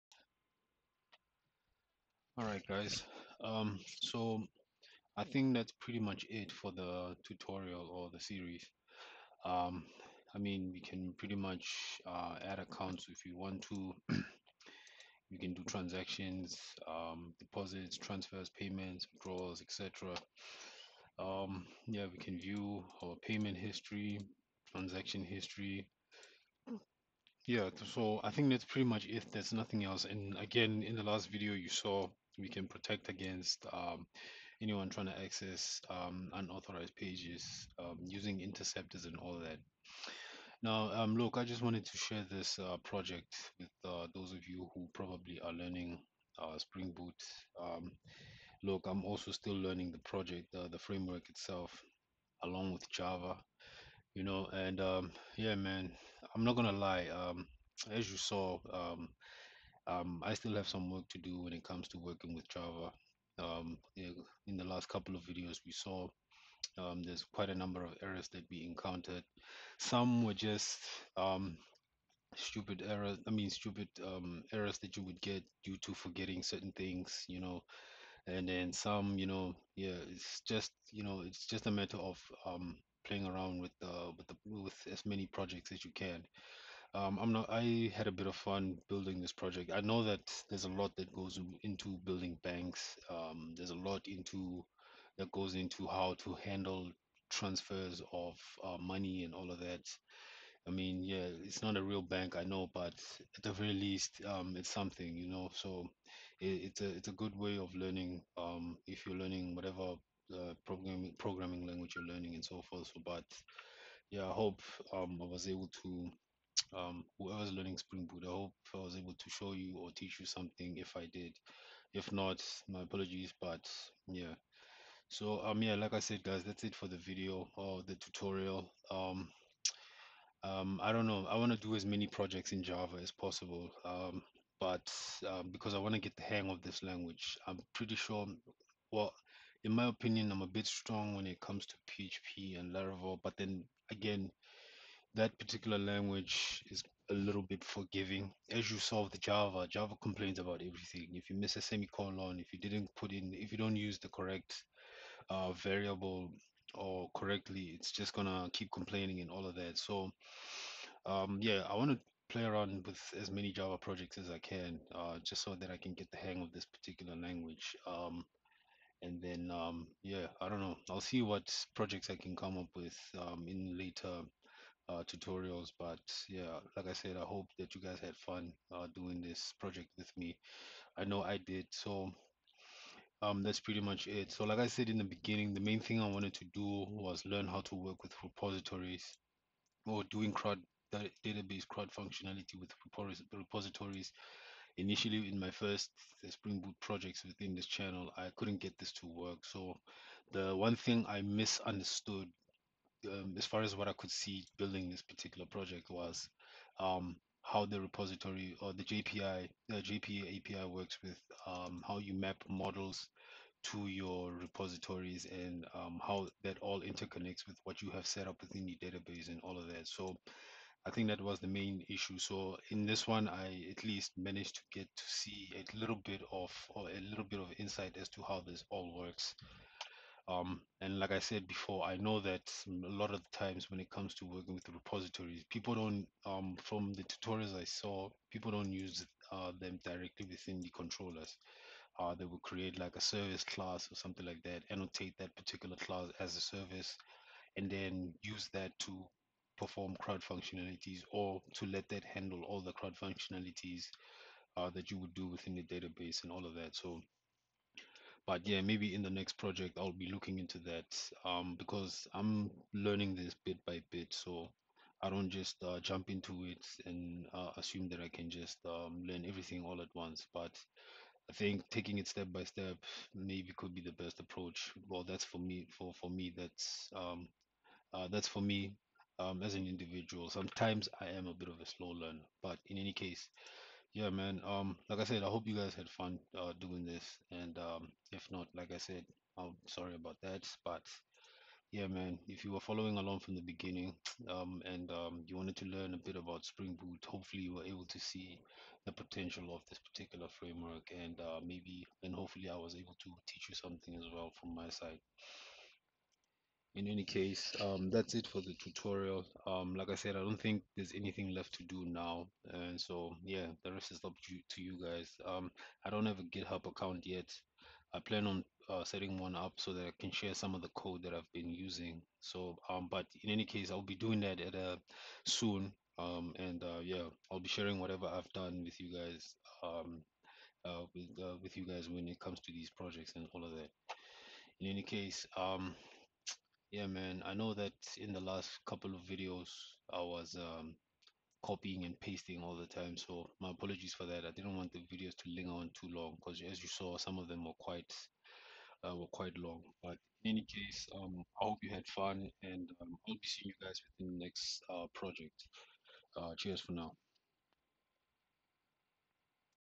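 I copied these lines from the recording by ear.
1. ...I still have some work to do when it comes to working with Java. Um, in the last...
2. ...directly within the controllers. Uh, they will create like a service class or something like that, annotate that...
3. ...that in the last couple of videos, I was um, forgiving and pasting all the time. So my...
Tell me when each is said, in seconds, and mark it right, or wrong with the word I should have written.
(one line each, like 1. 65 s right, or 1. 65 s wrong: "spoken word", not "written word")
1. 60 s right
2. 239 s right
3. 337 s wrong: "copying", not "forgiving".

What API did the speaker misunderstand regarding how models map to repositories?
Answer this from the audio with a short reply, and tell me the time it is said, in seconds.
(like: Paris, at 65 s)
JPA, at 209 s.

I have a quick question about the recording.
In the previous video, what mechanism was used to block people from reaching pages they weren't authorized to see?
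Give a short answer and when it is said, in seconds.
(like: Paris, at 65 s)
Interceptors, at 38 s.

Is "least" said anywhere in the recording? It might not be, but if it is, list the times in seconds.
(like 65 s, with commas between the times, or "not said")
103 s, 223 s.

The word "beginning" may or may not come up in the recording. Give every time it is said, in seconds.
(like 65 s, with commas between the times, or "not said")
185 s, 293 s.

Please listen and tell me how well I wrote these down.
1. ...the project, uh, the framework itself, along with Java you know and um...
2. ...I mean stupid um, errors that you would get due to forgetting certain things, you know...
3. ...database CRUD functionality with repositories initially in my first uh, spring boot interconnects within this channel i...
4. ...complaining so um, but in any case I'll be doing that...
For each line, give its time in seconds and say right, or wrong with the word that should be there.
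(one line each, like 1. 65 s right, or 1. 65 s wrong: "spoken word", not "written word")
1. 49 s right
2. 73 s right
3. 191 s wrong: "projects", not "interconnects"
4. 321 s wrong: "using", not "complaining".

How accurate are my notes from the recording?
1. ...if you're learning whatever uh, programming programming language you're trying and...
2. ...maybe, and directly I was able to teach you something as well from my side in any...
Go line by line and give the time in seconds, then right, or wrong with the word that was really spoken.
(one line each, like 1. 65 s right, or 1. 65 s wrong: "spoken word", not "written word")
1. 108 s wrong: "learning", not "trying"
2. 301 s wrong: "hopefully", not "directly".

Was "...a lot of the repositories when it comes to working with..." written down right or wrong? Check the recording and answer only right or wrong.
wrong.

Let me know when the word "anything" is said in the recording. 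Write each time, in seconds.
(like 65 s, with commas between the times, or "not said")
310 s.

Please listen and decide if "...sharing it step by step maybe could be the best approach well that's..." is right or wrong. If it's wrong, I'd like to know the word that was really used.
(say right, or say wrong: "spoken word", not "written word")
wrong: "taking", not "sharing".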